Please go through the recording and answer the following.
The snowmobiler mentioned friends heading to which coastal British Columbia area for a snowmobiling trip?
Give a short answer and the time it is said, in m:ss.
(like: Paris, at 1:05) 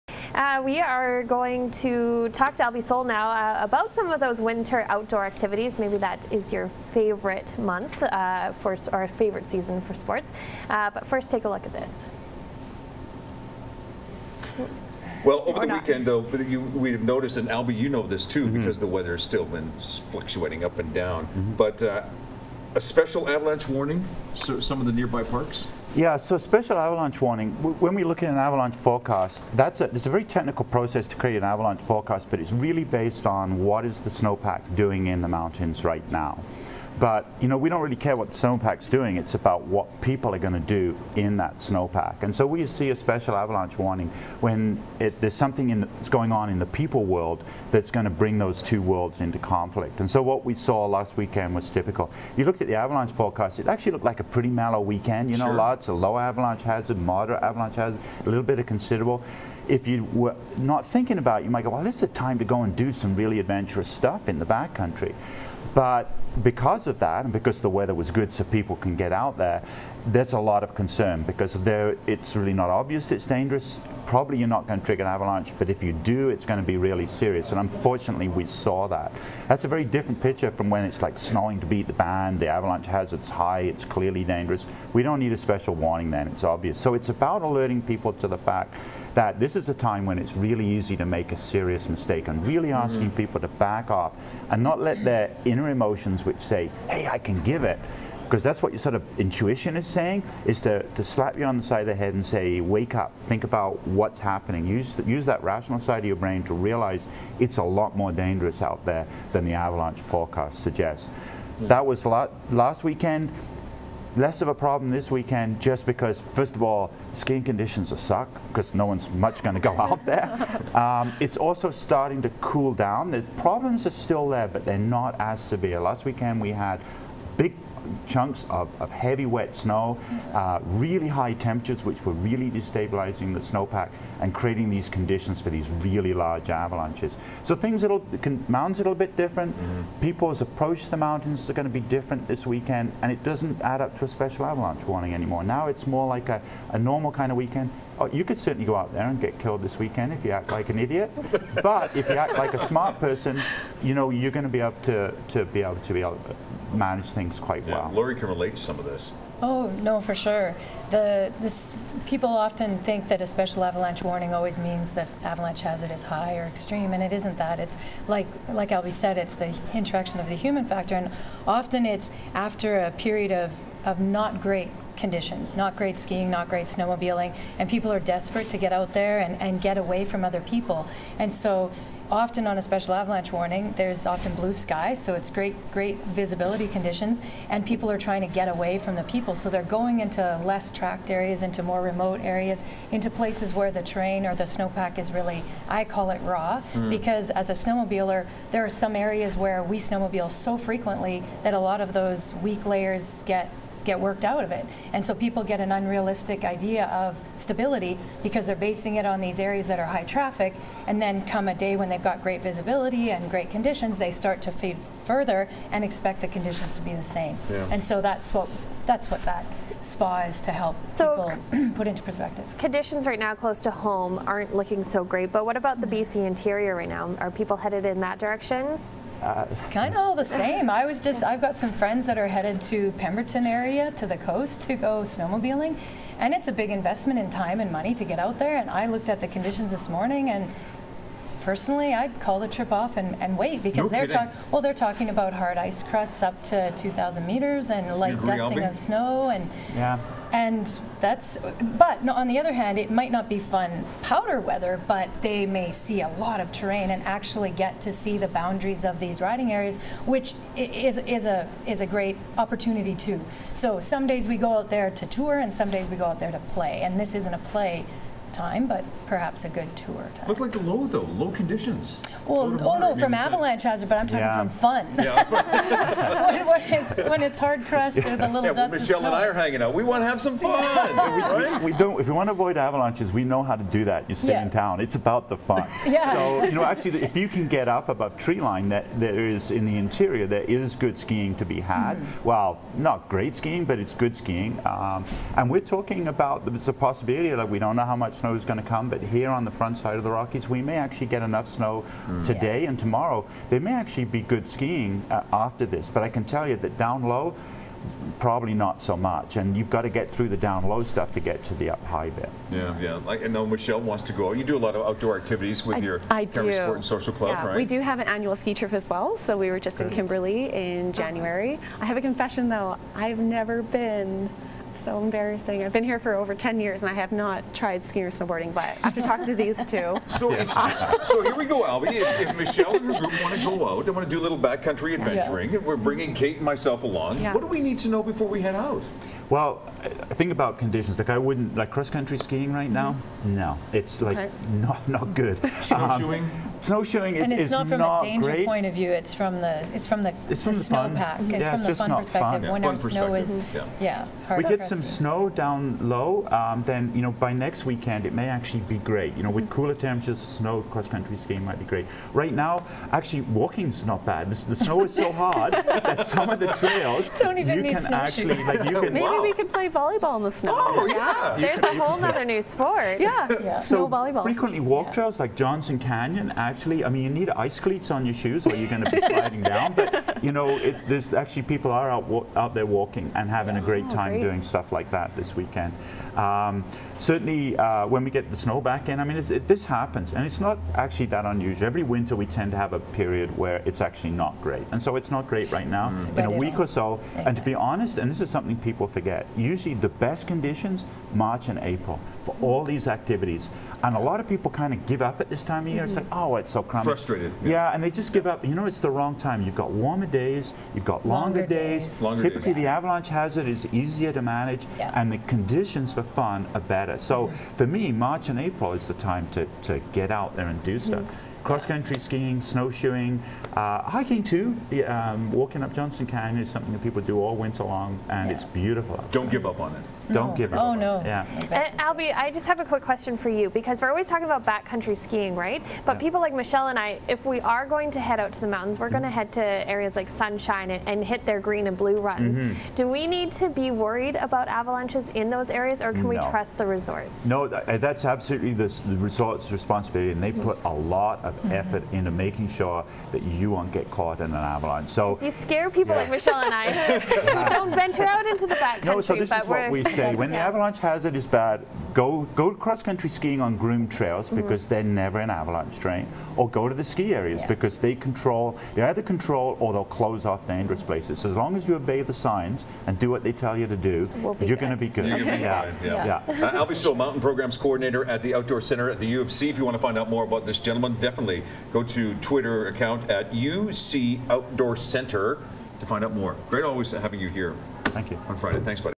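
Pemberton, at 3:52.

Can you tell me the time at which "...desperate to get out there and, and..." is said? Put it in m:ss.
2:57.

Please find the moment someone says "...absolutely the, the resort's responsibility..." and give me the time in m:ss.
7:28.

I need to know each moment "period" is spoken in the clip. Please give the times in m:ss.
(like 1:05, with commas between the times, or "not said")
2:52, 6:32.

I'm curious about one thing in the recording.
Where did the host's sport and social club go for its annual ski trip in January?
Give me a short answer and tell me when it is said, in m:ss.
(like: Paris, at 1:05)
Kimberley, at 5:19.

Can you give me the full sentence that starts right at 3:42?
Conditions right now close to home aren't looking so great, but what about the BC interior right now?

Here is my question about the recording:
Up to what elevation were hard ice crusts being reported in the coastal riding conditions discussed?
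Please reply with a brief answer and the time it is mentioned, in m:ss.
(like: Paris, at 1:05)
2,000 meters, at 4:06.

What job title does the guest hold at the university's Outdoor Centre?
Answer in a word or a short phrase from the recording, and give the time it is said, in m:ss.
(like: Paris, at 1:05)
Mountain Programs Coordinator, at 7:56.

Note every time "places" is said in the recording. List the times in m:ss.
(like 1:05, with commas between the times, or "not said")
3:13, 7:50.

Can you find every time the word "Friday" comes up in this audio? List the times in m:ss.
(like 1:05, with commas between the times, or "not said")
8:08.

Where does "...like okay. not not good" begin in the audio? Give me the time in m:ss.
5:44.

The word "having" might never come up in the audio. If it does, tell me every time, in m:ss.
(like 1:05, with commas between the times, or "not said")
6:23, 8:06.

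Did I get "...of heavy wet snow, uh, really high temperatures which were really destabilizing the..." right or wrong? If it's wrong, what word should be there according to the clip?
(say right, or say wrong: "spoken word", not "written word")
right.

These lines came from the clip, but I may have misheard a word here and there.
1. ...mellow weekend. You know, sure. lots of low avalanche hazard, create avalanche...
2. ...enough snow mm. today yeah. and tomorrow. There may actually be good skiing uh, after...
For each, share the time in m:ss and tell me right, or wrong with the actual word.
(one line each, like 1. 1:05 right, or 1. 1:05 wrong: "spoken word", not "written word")
1. 0:54 wrong: "moderate", not "create"
2. 5:01 right.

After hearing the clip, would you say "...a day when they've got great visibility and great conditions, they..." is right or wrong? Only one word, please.
right.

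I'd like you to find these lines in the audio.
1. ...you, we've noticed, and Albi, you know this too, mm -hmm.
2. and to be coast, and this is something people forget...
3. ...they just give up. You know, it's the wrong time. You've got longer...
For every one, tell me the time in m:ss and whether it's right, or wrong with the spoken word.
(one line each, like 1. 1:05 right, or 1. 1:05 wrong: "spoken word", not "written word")
1. 0:16 right
2. 6:37 wrong: "honest", not "coast"
3. 6:47 wrong: "warmer", not "longer".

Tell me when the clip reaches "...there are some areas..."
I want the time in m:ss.
3:18.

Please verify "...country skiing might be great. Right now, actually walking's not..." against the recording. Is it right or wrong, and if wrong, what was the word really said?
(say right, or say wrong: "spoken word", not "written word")
right.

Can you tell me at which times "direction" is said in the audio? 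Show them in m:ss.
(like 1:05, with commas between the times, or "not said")
3:48.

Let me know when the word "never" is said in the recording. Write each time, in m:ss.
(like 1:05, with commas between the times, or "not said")
5:23, 7:45.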